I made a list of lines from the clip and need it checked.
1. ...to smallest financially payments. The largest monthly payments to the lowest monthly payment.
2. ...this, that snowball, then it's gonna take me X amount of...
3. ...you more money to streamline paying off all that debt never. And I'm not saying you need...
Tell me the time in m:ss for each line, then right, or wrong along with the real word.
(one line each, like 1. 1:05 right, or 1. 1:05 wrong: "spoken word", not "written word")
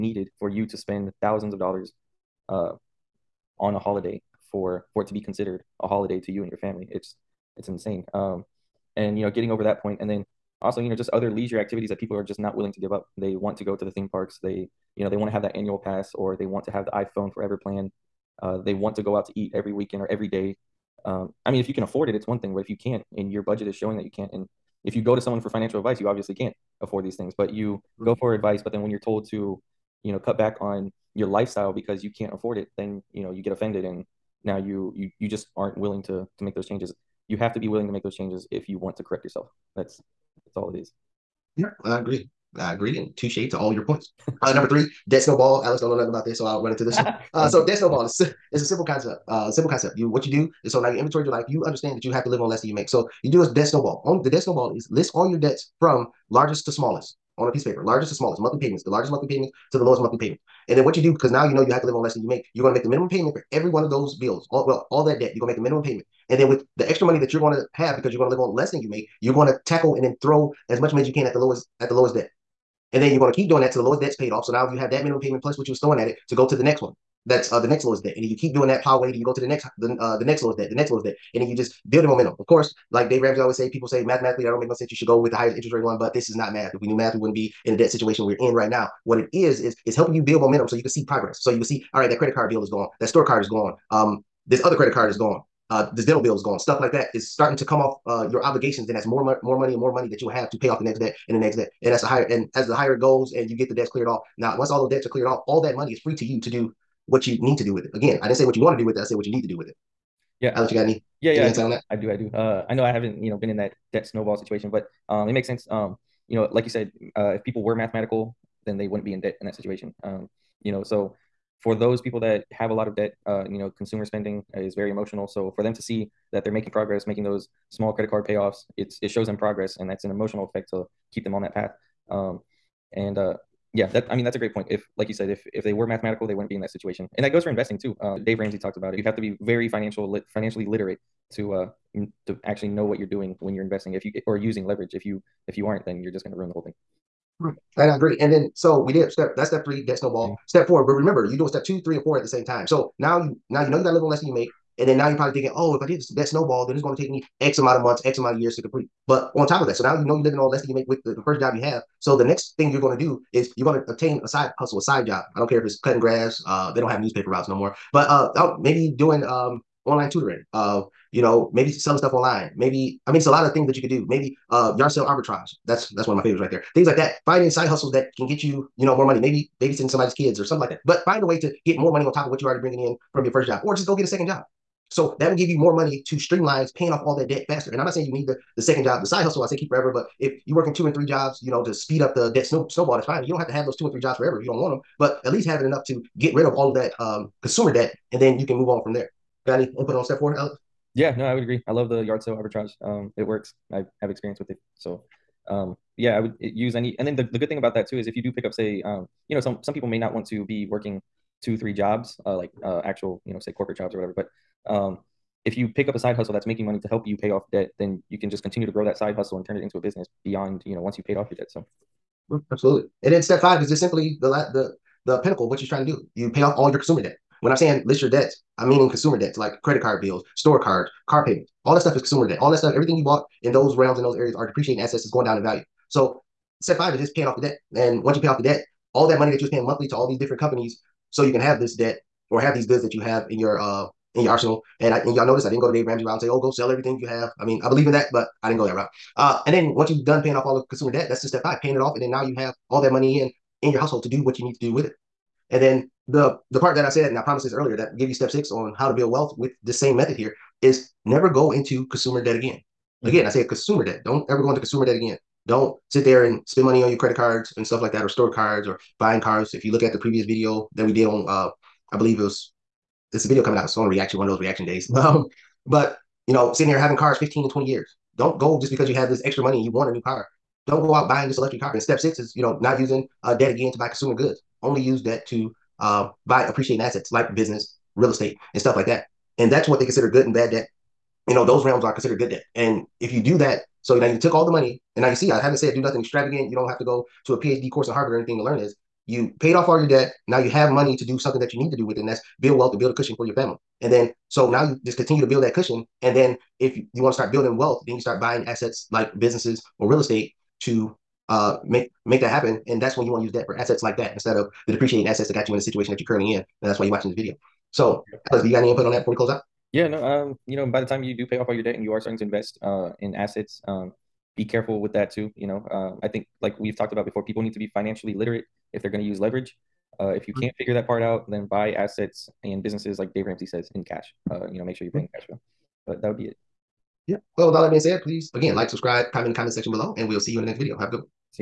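1. 0:58 wrong: "monthly", not "financially"
2. 2:35 right
3. 3:05 wrong: "faster", not "never".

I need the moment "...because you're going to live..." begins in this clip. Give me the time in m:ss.
1:07.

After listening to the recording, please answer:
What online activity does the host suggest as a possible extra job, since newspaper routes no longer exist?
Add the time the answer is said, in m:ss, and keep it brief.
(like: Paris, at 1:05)
Online tutoring, at 2:49.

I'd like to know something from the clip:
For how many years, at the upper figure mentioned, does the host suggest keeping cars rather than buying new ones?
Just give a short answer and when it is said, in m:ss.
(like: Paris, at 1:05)
20 years, at 4:37.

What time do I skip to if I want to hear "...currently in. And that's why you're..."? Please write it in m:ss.
5:16.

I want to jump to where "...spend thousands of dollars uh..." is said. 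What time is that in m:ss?
0:00.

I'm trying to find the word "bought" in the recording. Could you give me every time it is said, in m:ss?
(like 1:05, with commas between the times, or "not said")
3:53.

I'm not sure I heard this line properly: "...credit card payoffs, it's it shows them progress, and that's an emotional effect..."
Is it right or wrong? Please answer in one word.
right.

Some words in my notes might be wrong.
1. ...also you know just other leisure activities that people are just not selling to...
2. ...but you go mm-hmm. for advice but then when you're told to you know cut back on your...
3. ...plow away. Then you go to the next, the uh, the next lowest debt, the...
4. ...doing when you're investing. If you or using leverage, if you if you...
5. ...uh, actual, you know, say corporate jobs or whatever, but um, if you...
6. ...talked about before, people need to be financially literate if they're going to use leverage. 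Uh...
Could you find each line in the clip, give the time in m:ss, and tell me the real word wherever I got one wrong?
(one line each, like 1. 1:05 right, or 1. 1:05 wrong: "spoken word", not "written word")
1. 0:10 wrong: "willing", not "selling"
2. 0:27 right
3. 1:18 right
4. 2:23 right
5. 3:32 right
6. 5:26 right.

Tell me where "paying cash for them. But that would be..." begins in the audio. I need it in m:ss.
5:34.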